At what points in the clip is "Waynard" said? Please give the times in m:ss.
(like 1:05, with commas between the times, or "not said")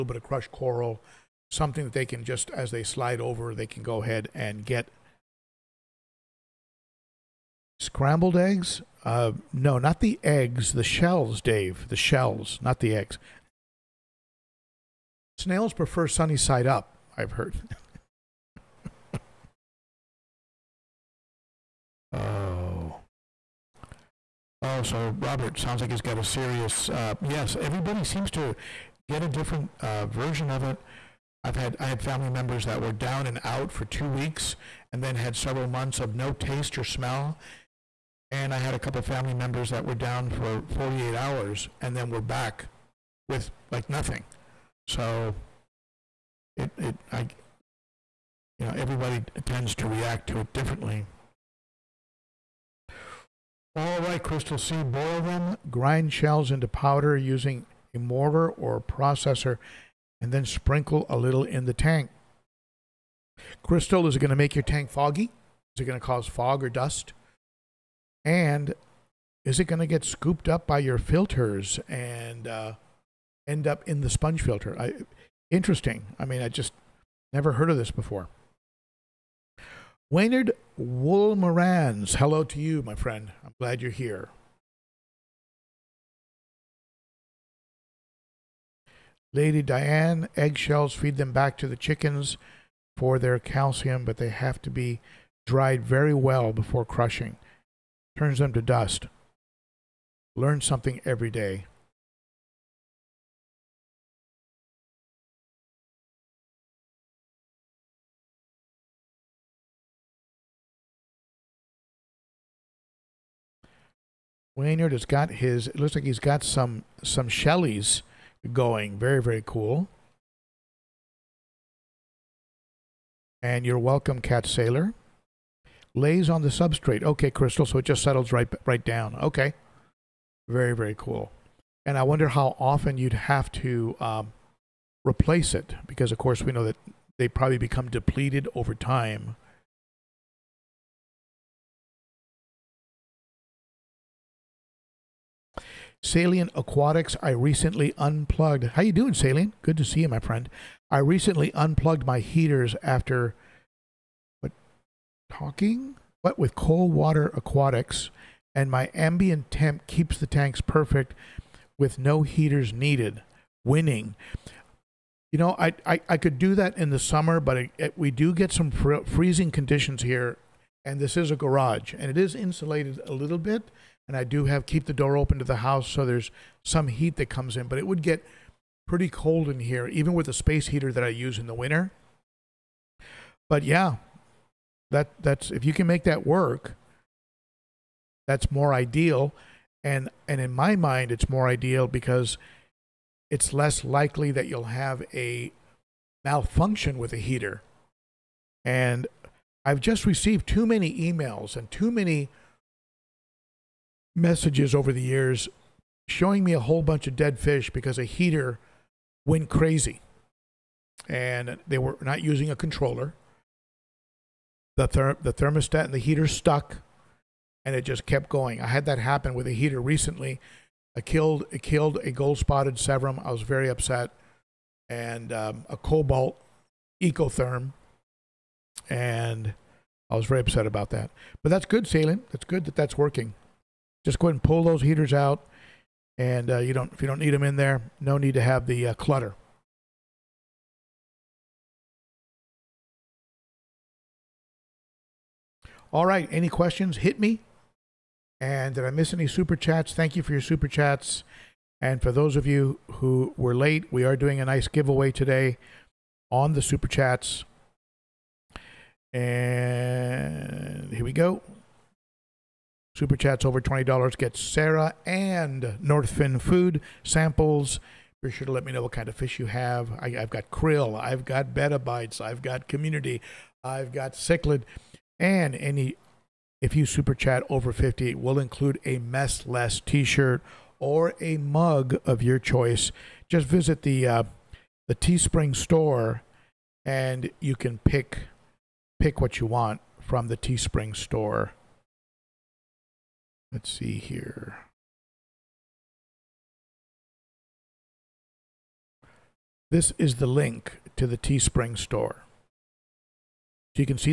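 1:20, 1:54.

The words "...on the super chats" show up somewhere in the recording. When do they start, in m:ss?
4:16.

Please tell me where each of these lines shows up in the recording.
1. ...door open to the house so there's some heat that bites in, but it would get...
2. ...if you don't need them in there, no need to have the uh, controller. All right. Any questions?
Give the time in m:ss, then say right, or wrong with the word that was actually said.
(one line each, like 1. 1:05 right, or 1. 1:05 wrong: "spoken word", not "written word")
1. 2:54 wrong: "comes", not "bites"
2. 3:56 wrong: "clutter", not "controller".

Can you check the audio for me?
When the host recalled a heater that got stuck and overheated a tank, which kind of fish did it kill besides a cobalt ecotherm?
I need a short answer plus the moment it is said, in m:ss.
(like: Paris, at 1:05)
Gold spotted Severum, at 3:42.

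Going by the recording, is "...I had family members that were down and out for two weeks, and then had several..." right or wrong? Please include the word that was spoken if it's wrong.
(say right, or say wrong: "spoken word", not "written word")
right.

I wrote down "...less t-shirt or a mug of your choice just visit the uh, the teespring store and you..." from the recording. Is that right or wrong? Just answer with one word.
right.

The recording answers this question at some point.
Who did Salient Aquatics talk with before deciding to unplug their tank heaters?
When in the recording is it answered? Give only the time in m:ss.
2:36.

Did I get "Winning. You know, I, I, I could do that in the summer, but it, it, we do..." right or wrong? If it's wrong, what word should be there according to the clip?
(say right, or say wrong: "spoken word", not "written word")
right.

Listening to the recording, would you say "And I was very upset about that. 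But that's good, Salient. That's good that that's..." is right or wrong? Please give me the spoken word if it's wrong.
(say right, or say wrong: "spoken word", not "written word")
right.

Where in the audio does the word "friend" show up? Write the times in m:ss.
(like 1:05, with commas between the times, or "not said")
1:22, 2:30.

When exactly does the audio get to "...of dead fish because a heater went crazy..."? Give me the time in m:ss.
3:27.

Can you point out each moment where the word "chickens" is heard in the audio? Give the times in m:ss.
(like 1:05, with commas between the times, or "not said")
1:31.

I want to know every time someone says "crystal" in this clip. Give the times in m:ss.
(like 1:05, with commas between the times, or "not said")
0:54, 1:03, 2:07.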